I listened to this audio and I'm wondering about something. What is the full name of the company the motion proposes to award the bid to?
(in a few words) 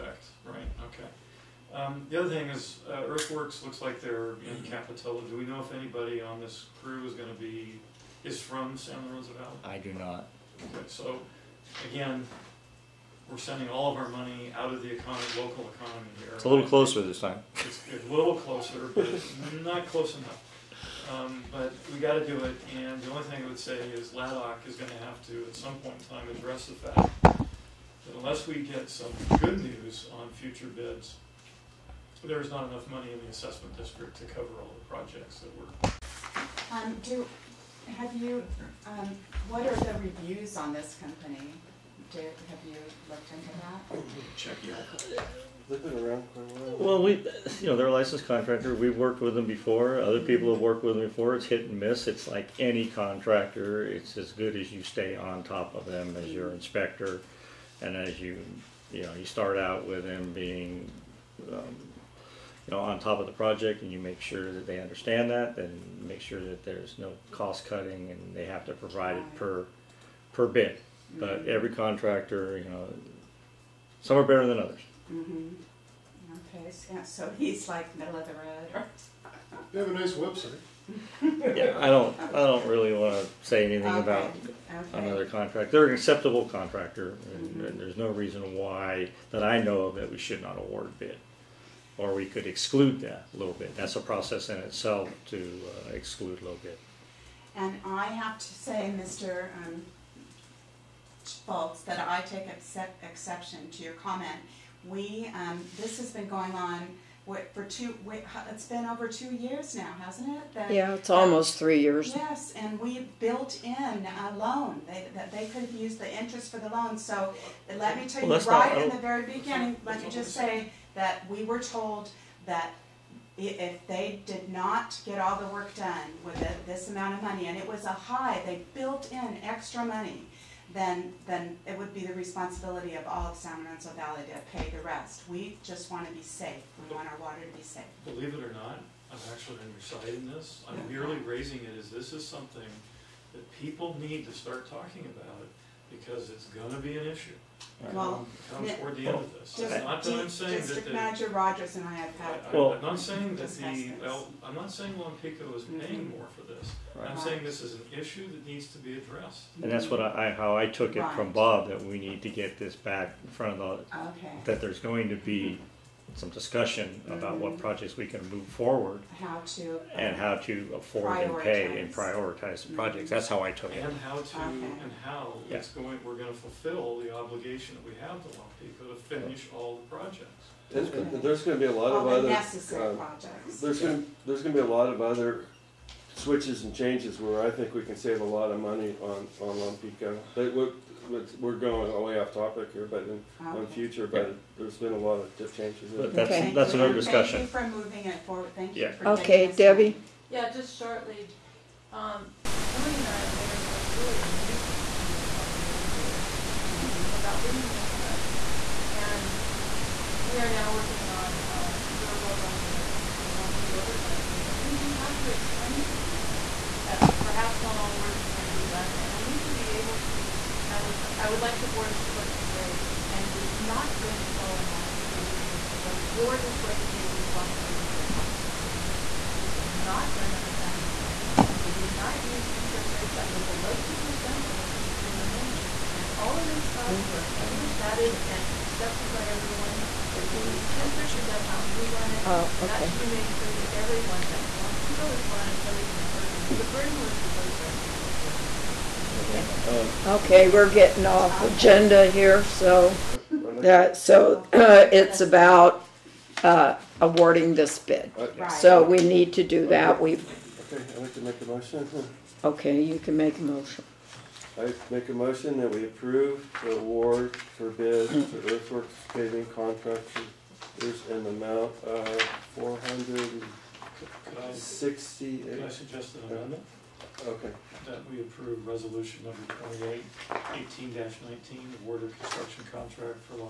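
Earthworks Paving Contractors.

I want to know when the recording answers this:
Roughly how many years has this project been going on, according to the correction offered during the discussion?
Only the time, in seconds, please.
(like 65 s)
111 s.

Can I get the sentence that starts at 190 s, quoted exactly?
But we're going way off topic here, but in, um, on future, but there's been a lot of changes.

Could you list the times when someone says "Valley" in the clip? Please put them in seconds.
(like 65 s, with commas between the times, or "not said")
9 s, 133 s.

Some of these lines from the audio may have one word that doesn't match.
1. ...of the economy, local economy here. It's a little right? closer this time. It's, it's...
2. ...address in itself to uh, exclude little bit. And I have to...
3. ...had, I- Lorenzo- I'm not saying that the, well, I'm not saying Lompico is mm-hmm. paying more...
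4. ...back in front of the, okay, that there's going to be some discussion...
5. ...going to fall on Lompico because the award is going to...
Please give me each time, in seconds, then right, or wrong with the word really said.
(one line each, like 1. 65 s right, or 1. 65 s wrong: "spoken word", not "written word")
1. 14 s right
2. 94 s wrong: "process", not "address"
3. 152 s wrong: "Well", not "Lorenzo"
4. 162 s right
5. 224 s wrong: "board", not "award".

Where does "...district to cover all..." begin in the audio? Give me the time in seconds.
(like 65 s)
33 s.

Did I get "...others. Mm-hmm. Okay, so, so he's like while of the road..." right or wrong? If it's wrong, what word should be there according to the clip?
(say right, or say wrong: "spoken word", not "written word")
wrong: "middle", not "while".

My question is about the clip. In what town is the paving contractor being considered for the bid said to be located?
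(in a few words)
Capitola.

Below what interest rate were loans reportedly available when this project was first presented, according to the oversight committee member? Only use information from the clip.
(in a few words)
2%.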